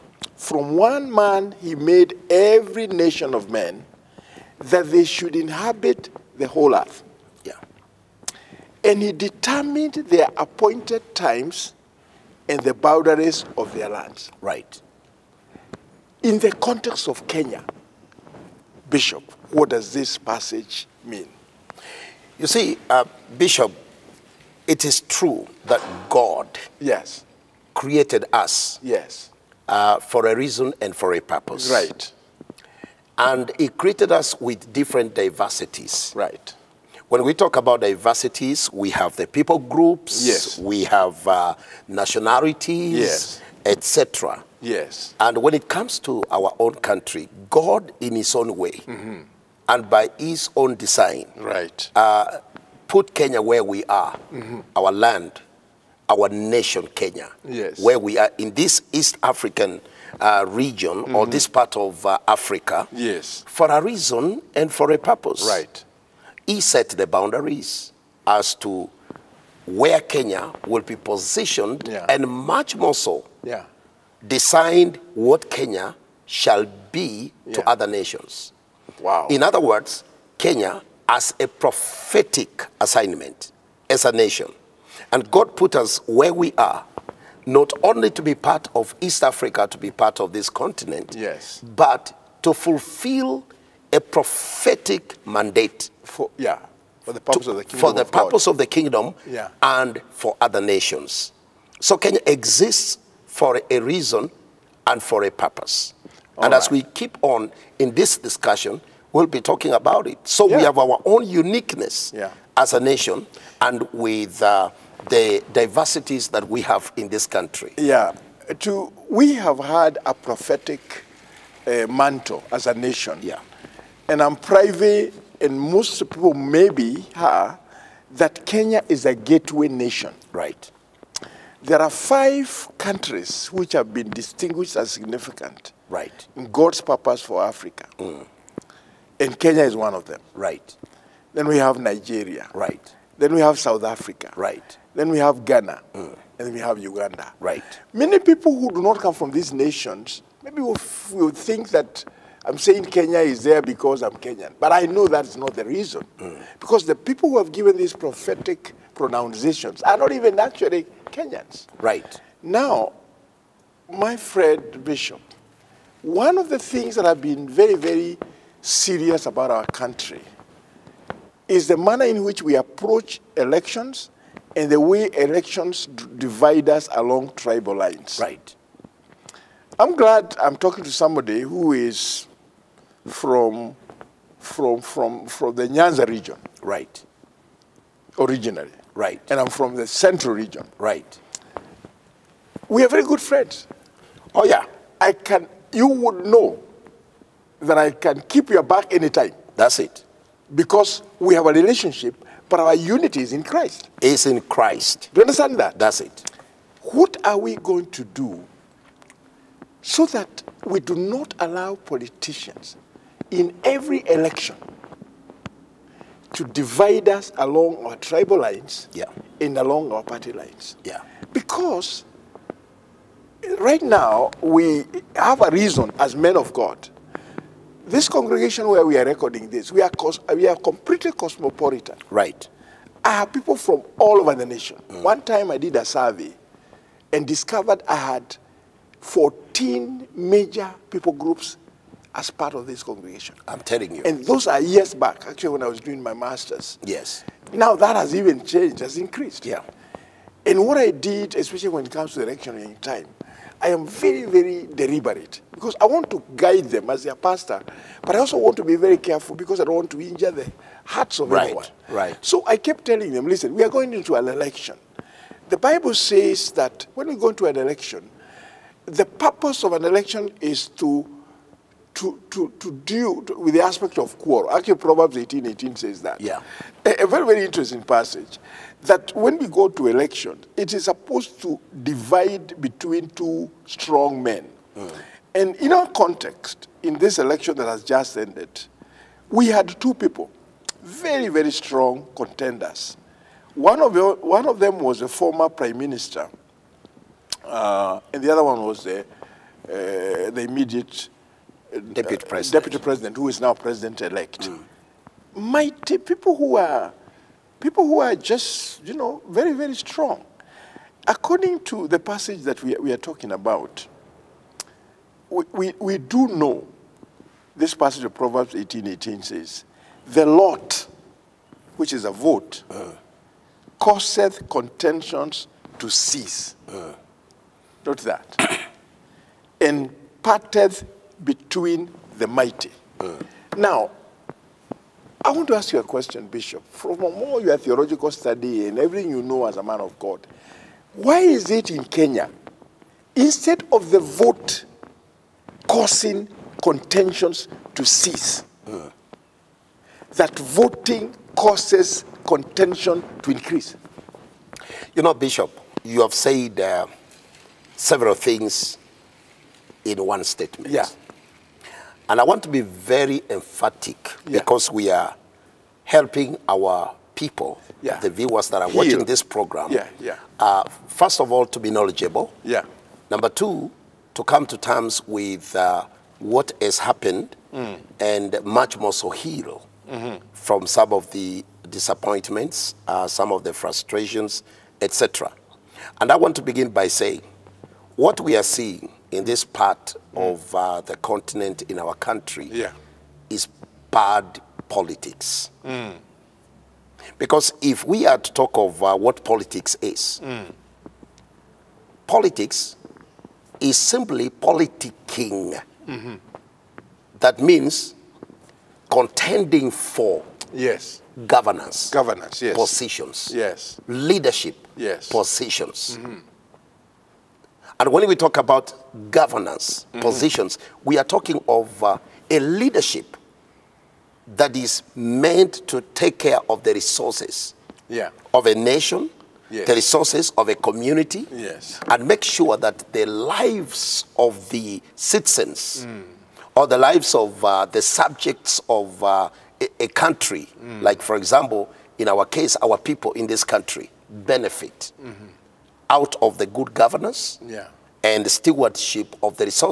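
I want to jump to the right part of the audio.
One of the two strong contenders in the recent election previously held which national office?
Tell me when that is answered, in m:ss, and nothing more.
4:55.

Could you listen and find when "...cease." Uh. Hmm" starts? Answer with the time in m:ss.
5:25.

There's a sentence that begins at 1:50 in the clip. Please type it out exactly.
we have our own uniqueness yeah.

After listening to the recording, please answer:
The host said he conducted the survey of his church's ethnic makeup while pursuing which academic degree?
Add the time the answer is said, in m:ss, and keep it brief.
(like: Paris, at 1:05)
Master's, at 4:05.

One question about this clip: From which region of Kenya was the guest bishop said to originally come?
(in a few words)
Nyanza.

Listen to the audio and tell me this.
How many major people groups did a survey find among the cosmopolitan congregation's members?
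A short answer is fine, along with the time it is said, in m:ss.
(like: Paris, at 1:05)
14, at 3:58.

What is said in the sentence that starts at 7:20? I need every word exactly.
like for example, in our case, our people in this country benefit.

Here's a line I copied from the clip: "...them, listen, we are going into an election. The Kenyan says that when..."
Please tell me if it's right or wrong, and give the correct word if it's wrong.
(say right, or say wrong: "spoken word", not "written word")
wrong: "Bible", not "Kenyan".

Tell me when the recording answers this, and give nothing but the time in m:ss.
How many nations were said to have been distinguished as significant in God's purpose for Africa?
2:11.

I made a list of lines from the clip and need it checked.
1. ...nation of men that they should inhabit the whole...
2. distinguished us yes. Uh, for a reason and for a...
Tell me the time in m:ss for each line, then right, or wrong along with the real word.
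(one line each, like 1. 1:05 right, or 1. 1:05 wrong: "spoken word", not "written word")
1. 0:02 right
2. 0:27 wrong: "created", not "distinguished".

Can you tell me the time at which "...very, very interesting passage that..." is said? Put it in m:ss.
4:37.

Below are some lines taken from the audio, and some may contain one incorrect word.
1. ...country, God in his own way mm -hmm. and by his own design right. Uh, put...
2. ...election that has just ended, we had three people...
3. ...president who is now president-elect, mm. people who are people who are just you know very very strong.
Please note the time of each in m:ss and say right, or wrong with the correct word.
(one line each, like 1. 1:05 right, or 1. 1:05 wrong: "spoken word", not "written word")
1. 0:46 right
2. 4:47 wrong: "two", not "three"
3. 5:02 right.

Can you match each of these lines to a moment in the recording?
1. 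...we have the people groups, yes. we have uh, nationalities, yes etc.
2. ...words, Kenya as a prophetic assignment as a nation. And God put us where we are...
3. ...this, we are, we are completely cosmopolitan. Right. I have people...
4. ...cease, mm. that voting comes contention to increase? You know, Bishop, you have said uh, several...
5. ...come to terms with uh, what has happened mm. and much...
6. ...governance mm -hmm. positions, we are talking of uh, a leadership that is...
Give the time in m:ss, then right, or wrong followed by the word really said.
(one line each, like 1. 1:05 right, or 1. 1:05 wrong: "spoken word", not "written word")
1. 0:38 right
2. 1:19 right
3. 3:49 right
4. 5:47 wrong: "causes", not "comes"
5. 6:14 right
6. 6:59 right.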